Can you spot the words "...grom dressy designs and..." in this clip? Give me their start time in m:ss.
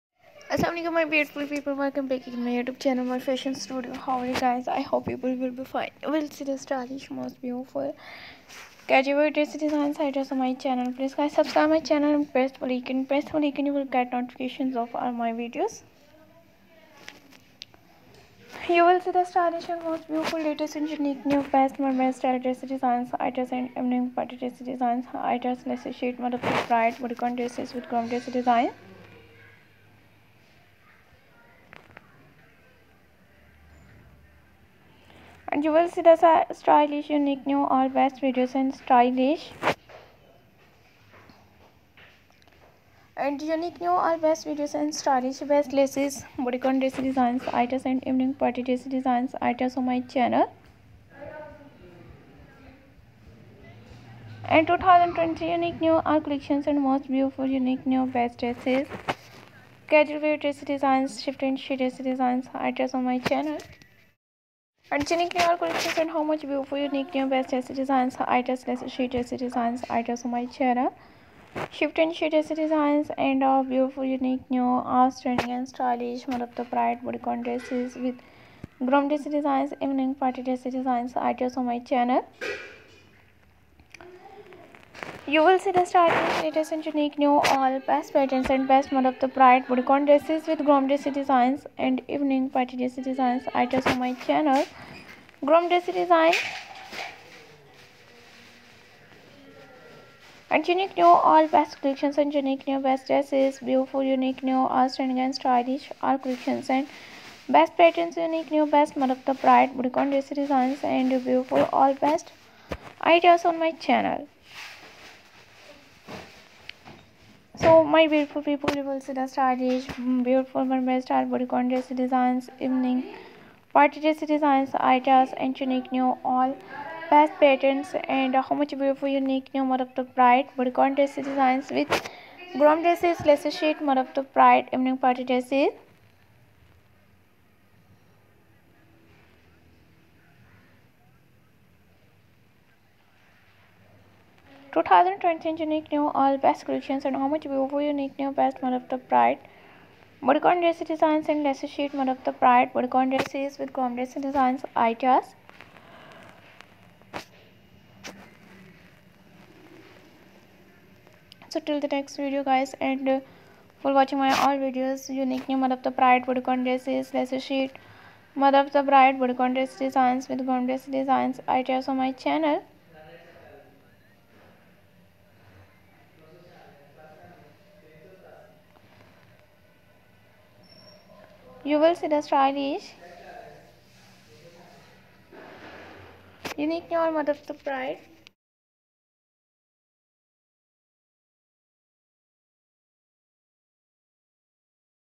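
1:30.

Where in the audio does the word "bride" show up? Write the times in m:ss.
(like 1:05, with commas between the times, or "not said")
2:10, 2:14, 2:48.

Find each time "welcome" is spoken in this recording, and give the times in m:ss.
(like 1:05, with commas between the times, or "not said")
0:01.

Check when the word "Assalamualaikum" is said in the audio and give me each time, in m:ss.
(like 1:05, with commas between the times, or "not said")
0:00.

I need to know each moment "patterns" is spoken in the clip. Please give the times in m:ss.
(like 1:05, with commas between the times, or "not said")
1:28, 1:47, 2:07.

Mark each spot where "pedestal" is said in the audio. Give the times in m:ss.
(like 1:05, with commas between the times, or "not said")
not said.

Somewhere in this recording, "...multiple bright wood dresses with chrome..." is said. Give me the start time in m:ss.
0:26.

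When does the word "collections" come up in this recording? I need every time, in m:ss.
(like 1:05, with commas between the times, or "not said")
0:56, 1:05, 1:41, 1:46, 2:26.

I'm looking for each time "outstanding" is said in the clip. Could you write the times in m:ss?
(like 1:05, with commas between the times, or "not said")
1:14, 1:44.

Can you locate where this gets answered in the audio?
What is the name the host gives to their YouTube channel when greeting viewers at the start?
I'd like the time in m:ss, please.
0:03.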